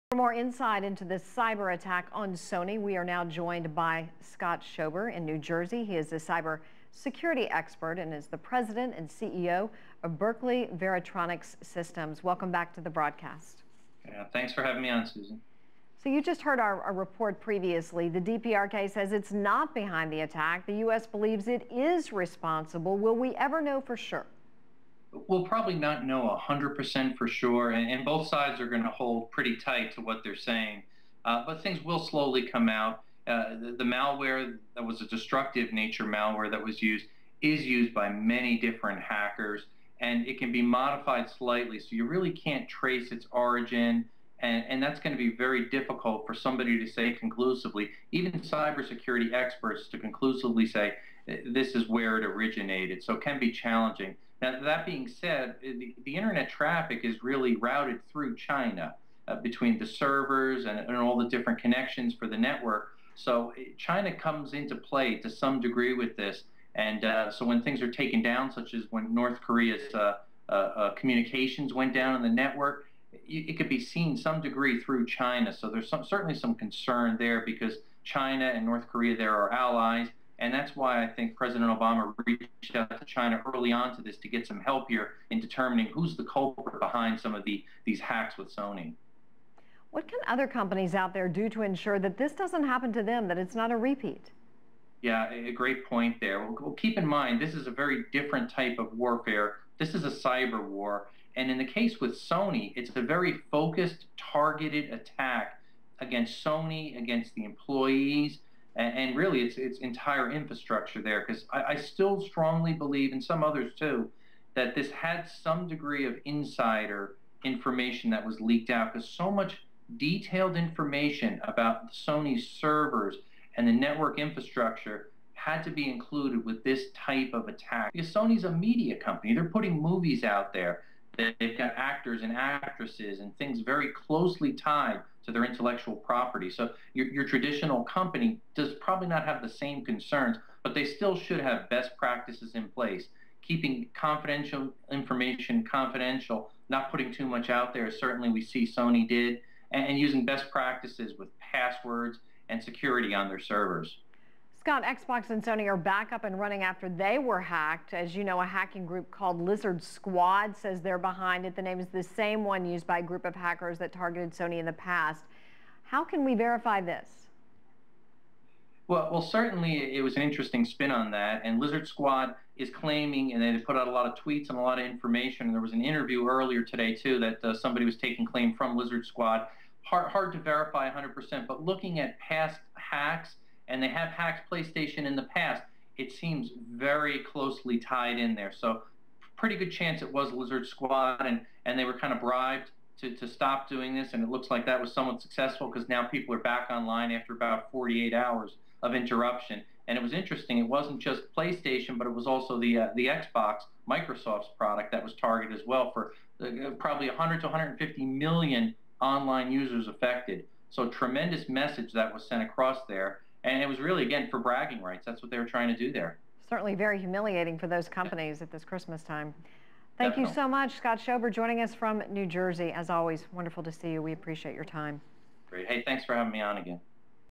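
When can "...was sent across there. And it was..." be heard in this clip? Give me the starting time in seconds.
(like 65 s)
212 s.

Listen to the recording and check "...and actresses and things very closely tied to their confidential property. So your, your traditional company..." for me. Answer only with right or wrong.
wrong.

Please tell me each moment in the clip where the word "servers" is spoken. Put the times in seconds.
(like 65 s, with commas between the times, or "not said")
59 s, 122 s, 153 s.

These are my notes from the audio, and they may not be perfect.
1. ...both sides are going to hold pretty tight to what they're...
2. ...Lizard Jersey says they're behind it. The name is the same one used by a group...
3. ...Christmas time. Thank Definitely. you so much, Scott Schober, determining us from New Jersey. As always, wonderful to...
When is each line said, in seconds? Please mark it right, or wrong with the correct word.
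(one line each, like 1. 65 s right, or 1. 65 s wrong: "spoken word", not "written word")
1. 28 s right
2. 159 s wrong: "Squad", not "Jersey"
3. 218 s wrong: "joining", not "determining".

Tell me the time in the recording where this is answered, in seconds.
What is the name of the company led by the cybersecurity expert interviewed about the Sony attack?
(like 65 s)
10 s.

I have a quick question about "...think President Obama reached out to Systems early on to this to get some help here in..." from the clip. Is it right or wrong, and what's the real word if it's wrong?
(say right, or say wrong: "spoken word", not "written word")
wrong: "China", not "Systems".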